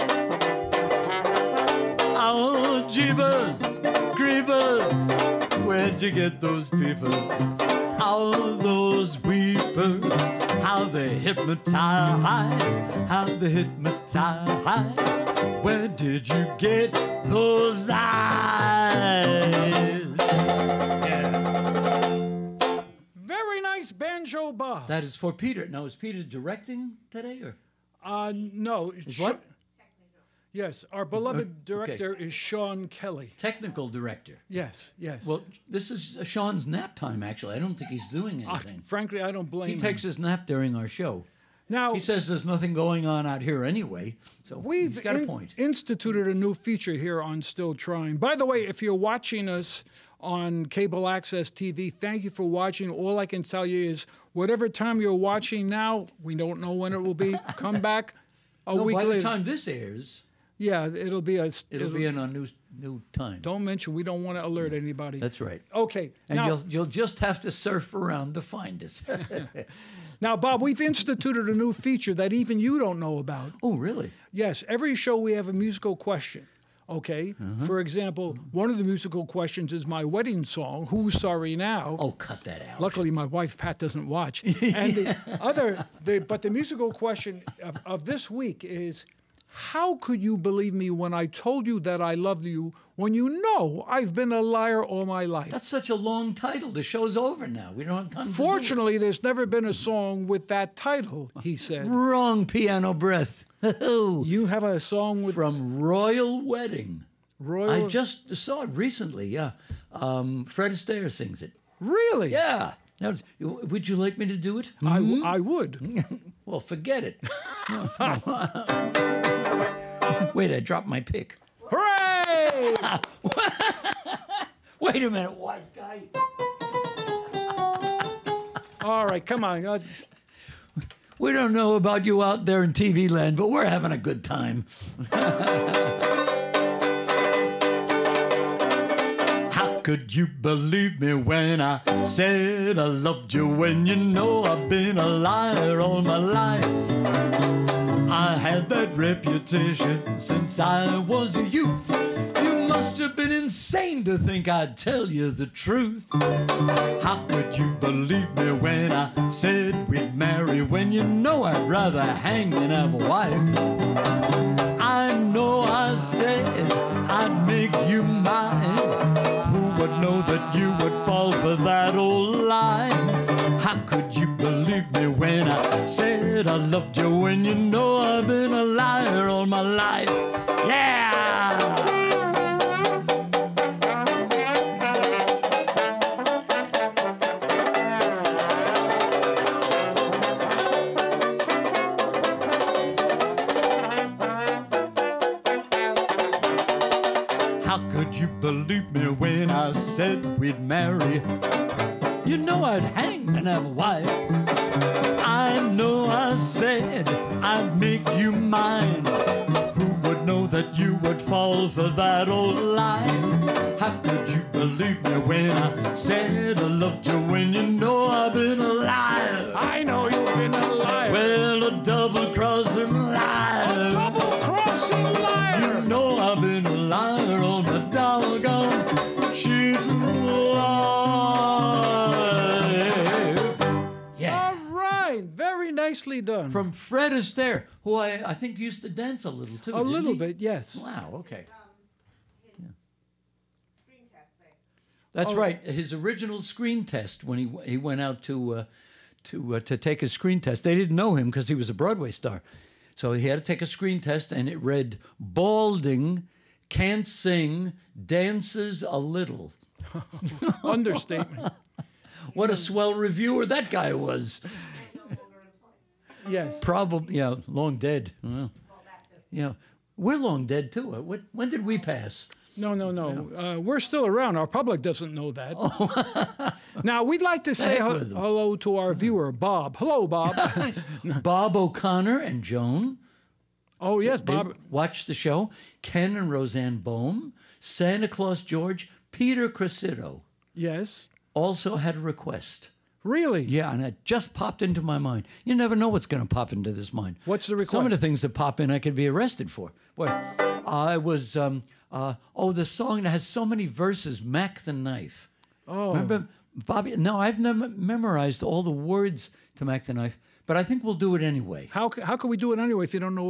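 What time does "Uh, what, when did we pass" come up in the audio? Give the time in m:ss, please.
4:30.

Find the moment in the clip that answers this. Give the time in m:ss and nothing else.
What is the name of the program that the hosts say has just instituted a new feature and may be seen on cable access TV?
0:47.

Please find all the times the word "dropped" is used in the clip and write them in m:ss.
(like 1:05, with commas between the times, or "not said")
2:00.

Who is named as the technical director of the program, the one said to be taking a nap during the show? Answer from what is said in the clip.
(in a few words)
Sean Kelly.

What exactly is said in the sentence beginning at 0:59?
By the time this airs, yeah, it'll be a.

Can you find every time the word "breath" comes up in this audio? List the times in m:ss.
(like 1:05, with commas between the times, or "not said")
1:42.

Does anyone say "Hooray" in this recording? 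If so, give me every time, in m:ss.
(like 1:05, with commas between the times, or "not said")
2:01.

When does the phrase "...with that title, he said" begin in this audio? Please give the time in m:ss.
1:40.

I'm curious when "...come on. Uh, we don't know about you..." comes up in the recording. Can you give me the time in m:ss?
2:09.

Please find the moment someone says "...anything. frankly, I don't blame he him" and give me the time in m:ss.
0:38.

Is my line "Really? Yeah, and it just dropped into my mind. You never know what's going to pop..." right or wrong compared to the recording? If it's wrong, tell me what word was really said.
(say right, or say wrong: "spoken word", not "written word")
wrong: "popped", not "dropped".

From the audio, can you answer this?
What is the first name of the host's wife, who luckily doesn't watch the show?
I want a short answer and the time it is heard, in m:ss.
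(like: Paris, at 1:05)
Pat, at 1:23.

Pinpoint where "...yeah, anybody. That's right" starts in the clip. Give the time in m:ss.
1:04.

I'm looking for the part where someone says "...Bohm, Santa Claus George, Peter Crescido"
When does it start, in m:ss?
4:46.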